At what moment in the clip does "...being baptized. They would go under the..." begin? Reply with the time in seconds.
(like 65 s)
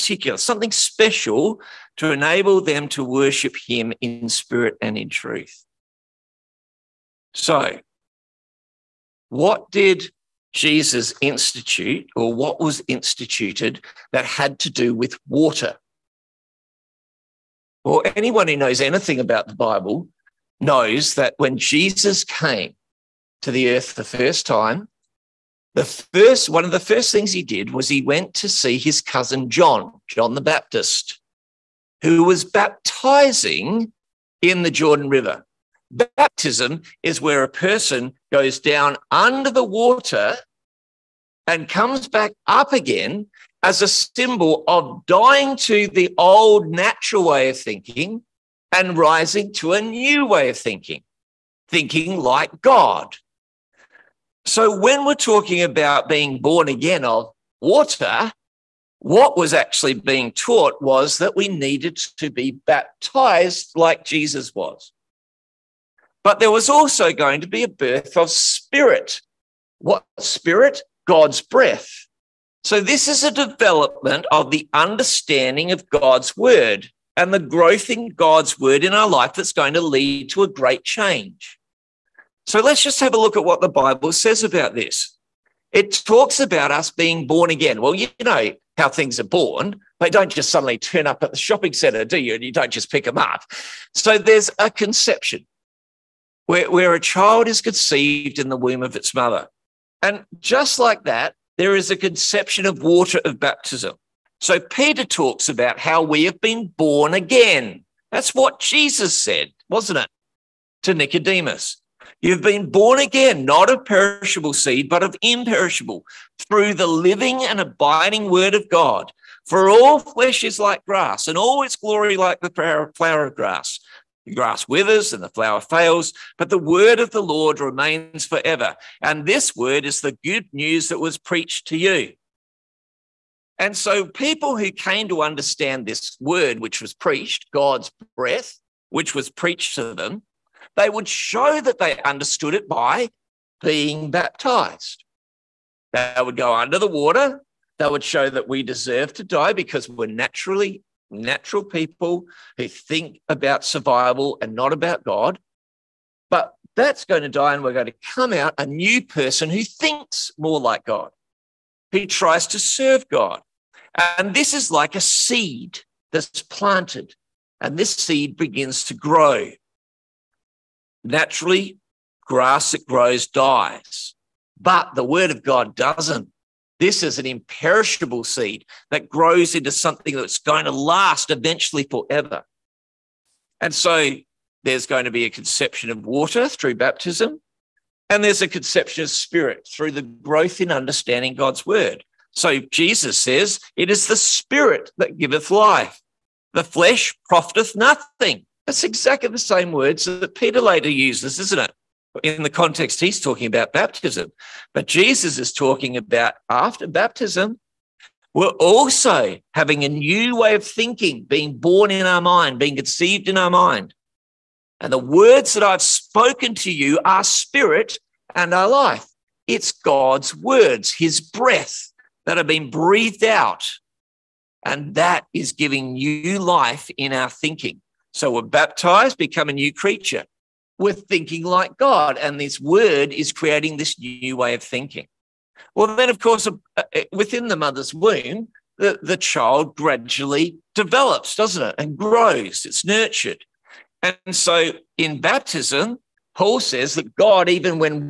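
143 s.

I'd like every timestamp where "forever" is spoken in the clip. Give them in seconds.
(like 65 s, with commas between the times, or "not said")
128 s, 181 s.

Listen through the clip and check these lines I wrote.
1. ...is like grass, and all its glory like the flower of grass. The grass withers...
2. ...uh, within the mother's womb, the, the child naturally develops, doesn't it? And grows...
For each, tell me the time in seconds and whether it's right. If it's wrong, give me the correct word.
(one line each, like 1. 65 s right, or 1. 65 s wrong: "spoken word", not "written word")
1. 120 s right
2. 236 s wrong: "gradually", not "naturally".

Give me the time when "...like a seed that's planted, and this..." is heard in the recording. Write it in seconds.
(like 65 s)
164 s.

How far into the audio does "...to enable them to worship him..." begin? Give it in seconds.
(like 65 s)
1 s.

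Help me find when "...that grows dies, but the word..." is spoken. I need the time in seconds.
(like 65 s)
172 s.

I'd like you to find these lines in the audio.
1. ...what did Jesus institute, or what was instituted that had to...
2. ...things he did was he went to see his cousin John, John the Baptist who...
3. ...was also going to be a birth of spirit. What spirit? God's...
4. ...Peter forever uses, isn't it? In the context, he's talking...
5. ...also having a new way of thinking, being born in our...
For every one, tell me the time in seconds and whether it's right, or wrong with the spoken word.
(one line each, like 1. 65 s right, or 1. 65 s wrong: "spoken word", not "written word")
1. 9 s right
2. 27 s right
3. 66 s right
4. 200 s wrong: "later", not "forever"
5. 208 s right.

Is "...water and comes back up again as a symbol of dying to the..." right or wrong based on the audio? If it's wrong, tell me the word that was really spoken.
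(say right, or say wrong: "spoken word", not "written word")
right.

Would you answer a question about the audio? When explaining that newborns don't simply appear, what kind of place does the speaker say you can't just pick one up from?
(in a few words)
shopping centre.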